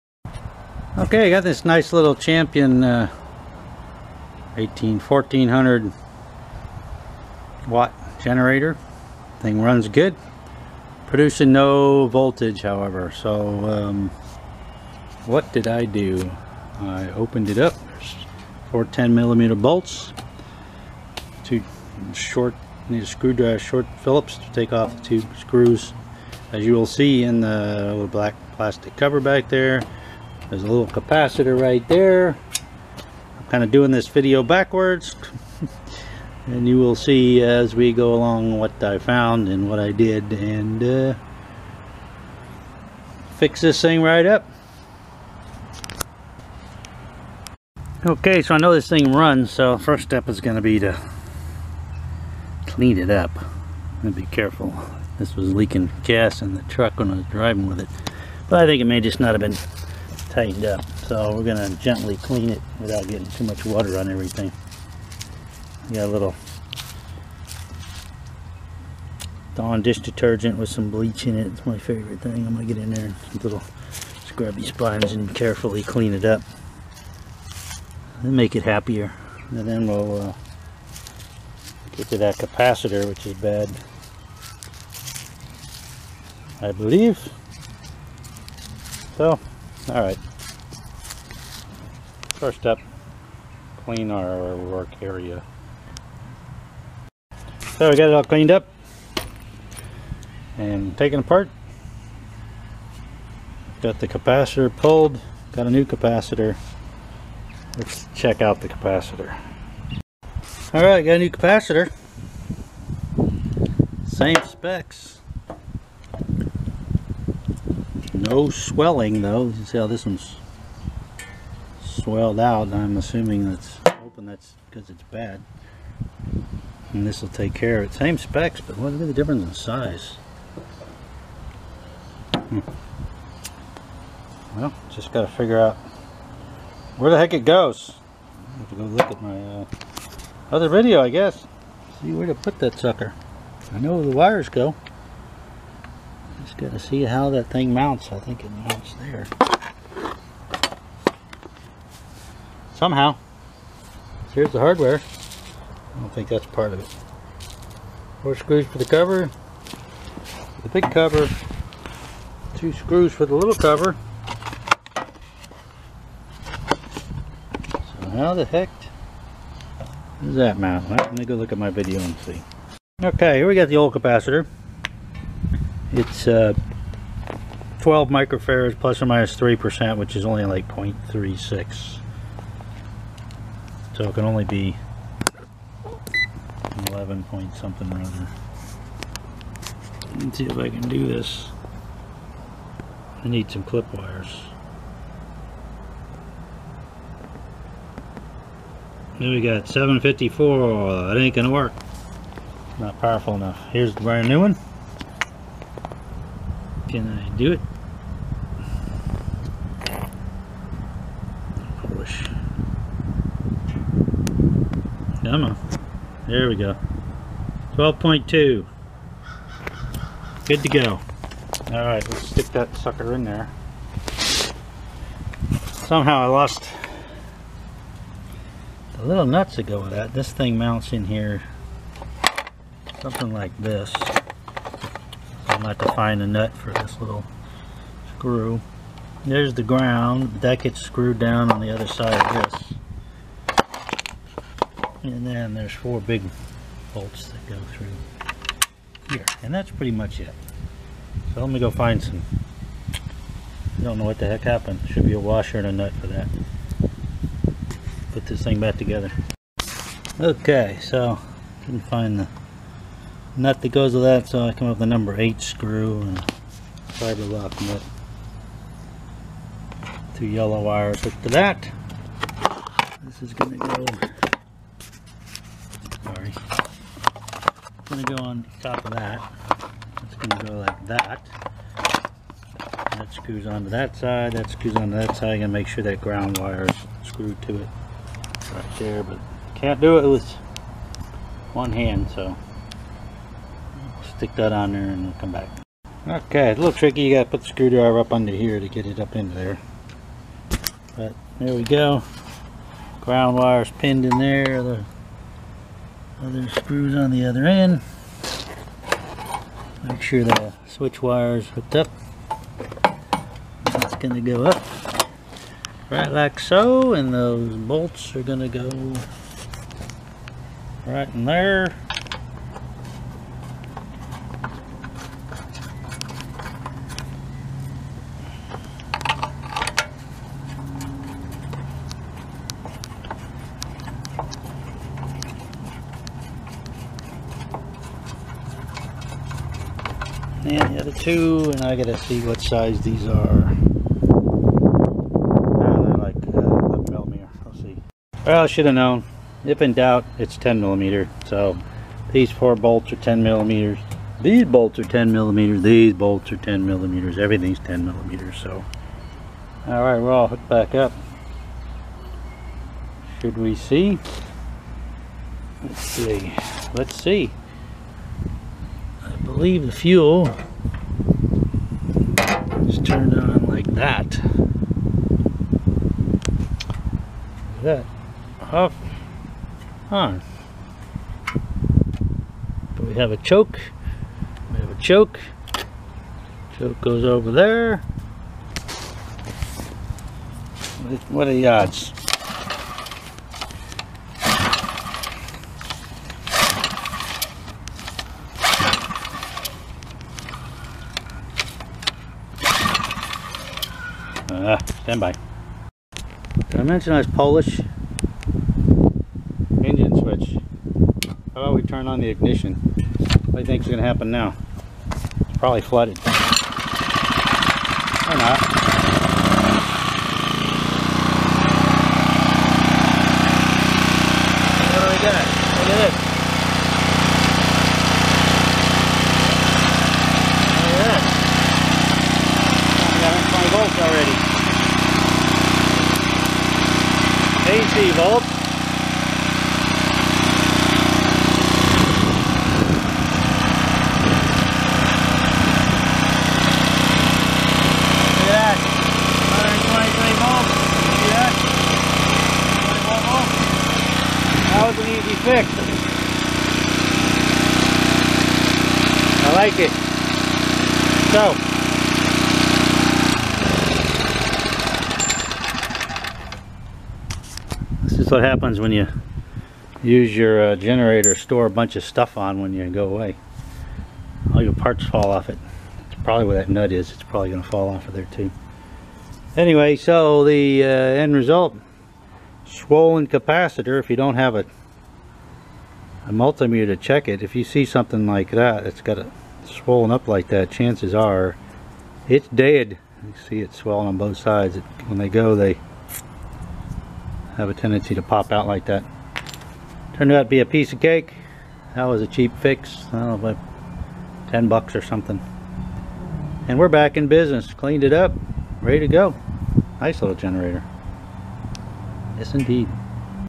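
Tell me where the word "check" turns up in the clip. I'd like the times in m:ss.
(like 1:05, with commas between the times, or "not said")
1:48, 8:06.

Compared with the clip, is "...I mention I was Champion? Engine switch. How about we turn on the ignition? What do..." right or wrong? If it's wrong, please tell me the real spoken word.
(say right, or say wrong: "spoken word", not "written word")
wrong: "Polish", not "Champion".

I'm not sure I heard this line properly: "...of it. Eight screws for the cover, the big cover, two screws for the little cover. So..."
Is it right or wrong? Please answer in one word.
wrong.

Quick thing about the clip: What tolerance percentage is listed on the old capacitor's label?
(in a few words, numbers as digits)
3%.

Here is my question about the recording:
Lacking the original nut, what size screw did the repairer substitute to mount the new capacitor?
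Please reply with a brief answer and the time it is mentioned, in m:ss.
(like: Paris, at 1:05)
number 8 screw, at 4:24.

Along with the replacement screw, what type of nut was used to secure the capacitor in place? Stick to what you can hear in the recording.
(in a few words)
fiber lock nut.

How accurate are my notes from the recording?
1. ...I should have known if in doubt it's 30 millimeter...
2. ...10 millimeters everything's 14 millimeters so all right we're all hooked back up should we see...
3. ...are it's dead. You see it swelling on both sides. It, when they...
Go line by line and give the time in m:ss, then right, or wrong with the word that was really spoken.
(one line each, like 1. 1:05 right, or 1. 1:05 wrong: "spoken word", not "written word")
1. 5:48 wrong: "10", not "30"
2. 5:56 wrong: "10", not "14"
3. 8:10 right.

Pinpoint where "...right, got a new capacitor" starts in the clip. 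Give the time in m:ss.
1:50.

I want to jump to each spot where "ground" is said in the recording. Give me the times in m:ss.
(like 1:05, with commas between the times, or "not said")
3:59, 4:46, 5:03.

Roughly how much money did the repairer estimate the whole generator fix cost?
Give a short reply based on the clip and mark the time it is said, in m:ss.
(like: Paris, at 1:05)
10 bucks, at 8:24.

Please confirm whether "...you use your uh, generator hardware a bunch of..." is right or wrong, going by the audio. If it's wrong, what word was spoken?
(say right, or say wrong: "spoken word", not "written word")
wrong: "store", not "hardware".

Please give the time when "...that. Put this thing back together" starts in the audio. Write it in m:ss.
4:16.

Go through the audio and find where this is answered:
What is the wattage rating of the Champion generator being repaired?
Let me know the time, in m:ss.
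0:04.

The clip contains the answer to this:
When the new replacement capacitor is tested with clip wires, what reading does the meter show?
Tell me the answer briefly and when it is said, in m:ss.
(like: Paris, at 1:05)
12.2, at 3:37.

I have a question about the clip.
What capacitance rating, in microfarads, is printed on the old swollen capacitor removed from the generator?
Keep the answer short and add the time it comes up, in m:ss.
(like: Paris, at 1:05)
12 microfarads, at 2:57.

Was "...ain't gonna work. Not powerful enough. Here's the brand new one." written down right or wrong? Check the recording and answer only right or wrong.
right.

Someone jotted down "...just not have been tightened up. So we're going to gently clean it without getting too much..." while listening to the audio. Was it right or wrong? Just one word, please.
right.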